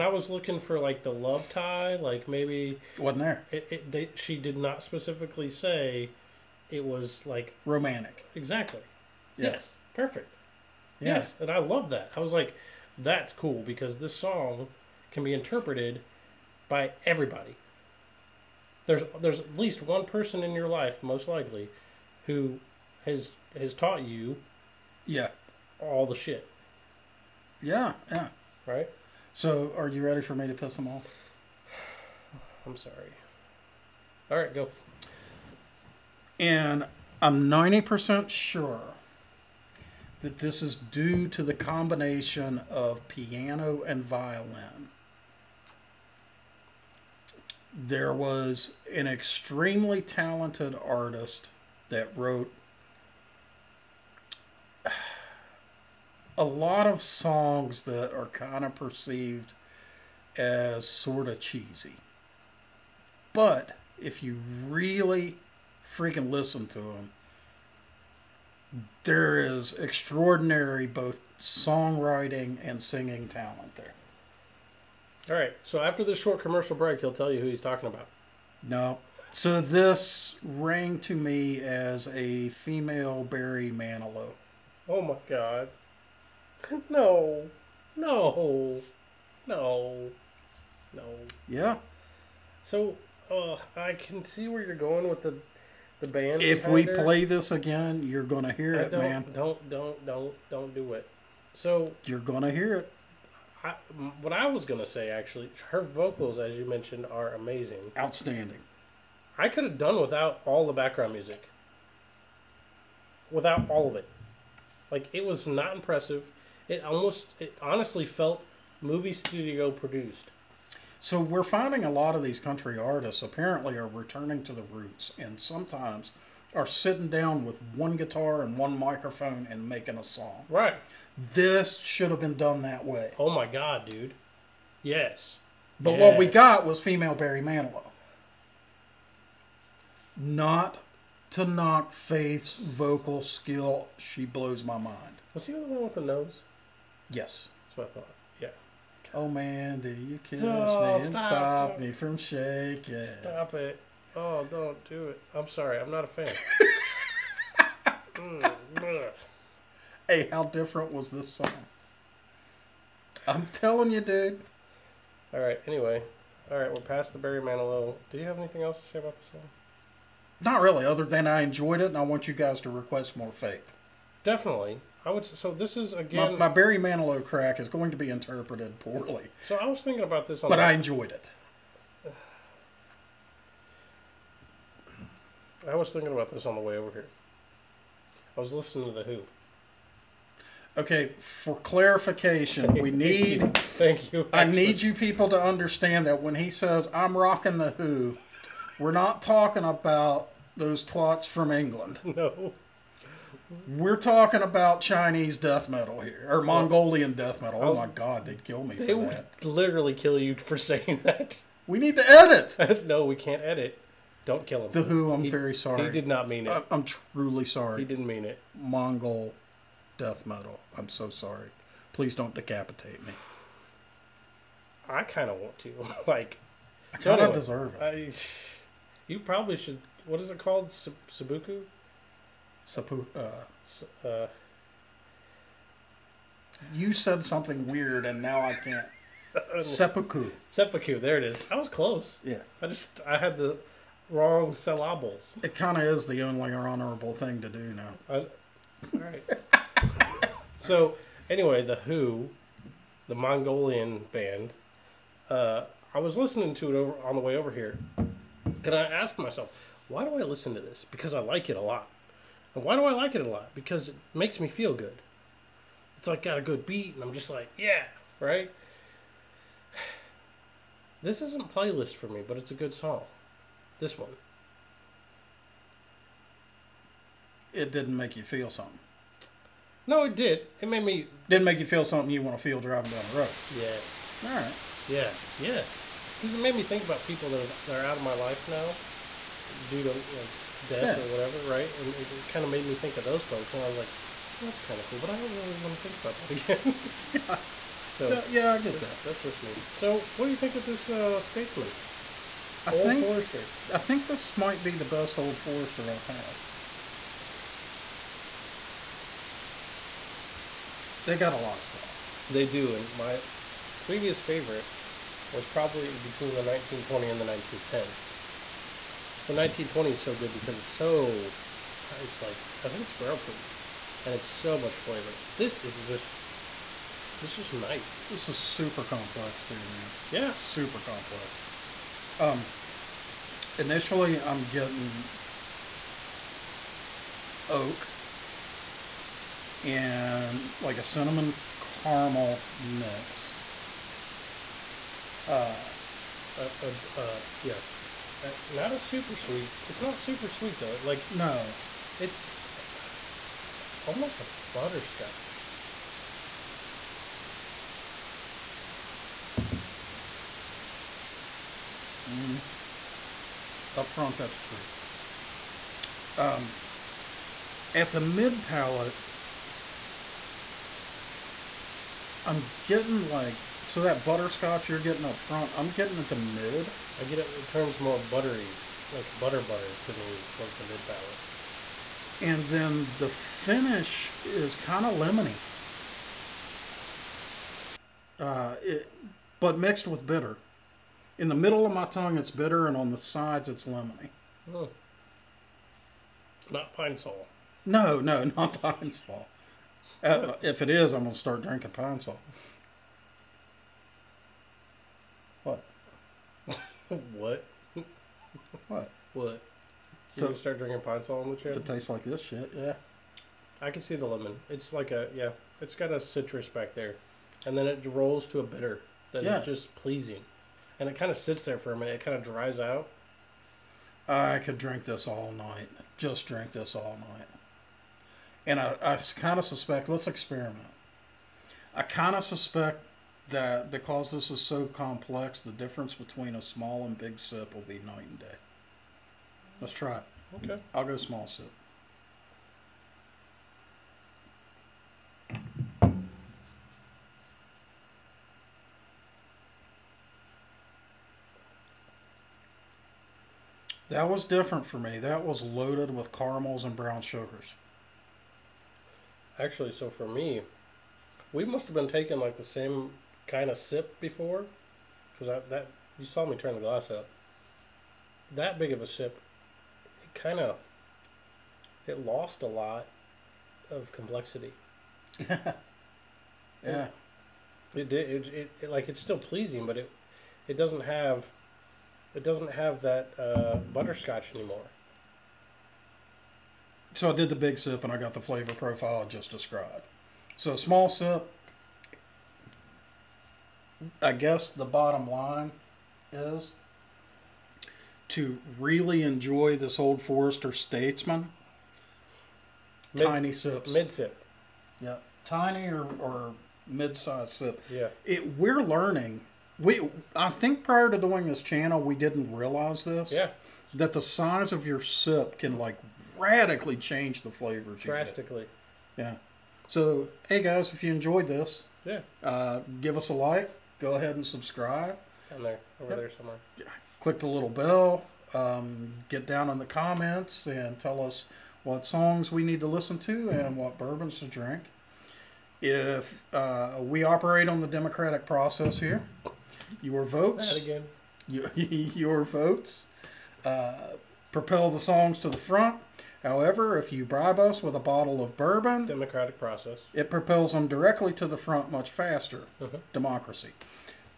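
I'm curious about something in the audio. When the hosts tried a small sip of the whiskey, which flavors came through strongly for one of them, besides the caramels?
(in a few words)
brown sugars.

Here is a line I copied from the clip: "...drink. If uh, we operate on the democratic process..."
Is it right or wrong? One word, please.
right.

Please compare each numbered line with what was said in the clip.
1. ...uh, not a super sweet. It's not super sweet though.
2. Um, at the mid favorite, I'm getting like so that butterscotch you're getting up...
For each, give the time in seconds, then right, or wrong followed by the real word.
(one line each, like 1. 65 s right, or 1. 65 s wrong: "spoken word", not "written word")
1. 348 s right
2. 366 s wrong: "palate", not "favorite".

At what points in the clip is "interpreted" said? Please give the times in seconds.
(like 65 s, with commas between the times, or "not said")
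15 s, 178 s.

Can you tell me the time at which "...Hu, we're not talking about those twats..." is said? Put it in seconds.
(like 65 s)
197 s.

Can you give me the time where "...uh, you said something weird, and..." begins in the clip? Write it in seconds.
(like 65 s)
234 s.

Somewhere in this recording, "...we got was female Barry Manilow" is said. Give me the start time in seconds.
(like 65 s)
136 s.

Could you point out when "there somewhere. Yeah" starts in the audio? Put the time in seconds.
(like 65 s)
525 s.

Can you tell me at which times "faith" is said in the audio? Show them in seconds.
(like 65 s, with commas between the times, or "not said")
141 s, 173 s.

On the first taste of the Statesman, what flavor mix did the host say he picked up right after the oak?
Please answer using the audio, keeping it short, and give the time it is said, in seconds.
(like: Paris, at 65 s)
cinnamon caramel, at 340 s.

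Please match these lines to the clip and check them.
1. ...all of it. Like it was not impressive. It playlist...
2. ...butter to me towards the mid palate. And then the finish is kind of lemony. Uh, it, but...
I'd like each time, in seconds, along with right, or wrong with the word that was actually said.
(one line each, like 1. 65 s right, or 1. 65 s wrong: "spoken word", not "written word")
1. 113 s wrong: "almost", not "playlist"
2. 379 s right.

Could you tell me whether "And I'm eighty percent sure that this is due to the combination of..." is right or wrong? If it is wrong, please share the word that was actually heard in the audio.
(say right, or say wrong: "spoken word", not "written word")
wrong: "ninety", not "eighty".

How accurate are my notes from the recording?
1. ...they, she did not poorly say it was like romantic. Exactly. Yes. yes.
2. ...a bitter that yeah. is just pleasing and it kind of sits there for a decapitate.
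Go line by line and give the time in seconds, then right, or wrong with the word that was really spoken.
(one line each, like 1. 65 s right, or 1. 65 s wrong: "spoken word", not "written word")
1. 3 s wrong: "specifically", not "poorly"
2. 418 s wrong: "minute", not "decapitate".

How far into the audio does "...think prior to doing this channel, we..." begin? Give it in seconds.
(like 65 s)
510 s.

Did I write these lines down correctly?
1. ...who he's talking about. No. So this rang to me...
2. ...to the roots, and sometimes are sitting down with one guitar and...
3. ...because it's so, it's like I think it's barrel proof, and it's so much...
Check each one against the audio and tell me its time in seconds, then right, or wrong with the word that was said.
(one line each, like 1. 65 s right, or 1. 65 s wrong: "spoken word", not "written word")
1. 77 s right
2. 124 s right
3. 320 s right.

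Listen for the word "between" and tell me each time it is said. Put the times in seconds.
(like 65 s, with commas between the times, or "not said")
315 s, 435 s.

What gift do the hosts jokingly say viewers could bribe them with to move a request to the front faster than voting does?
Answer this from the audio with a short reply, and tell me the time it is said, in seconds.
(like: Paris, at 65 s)
a bottle of bourbon, at 547 s.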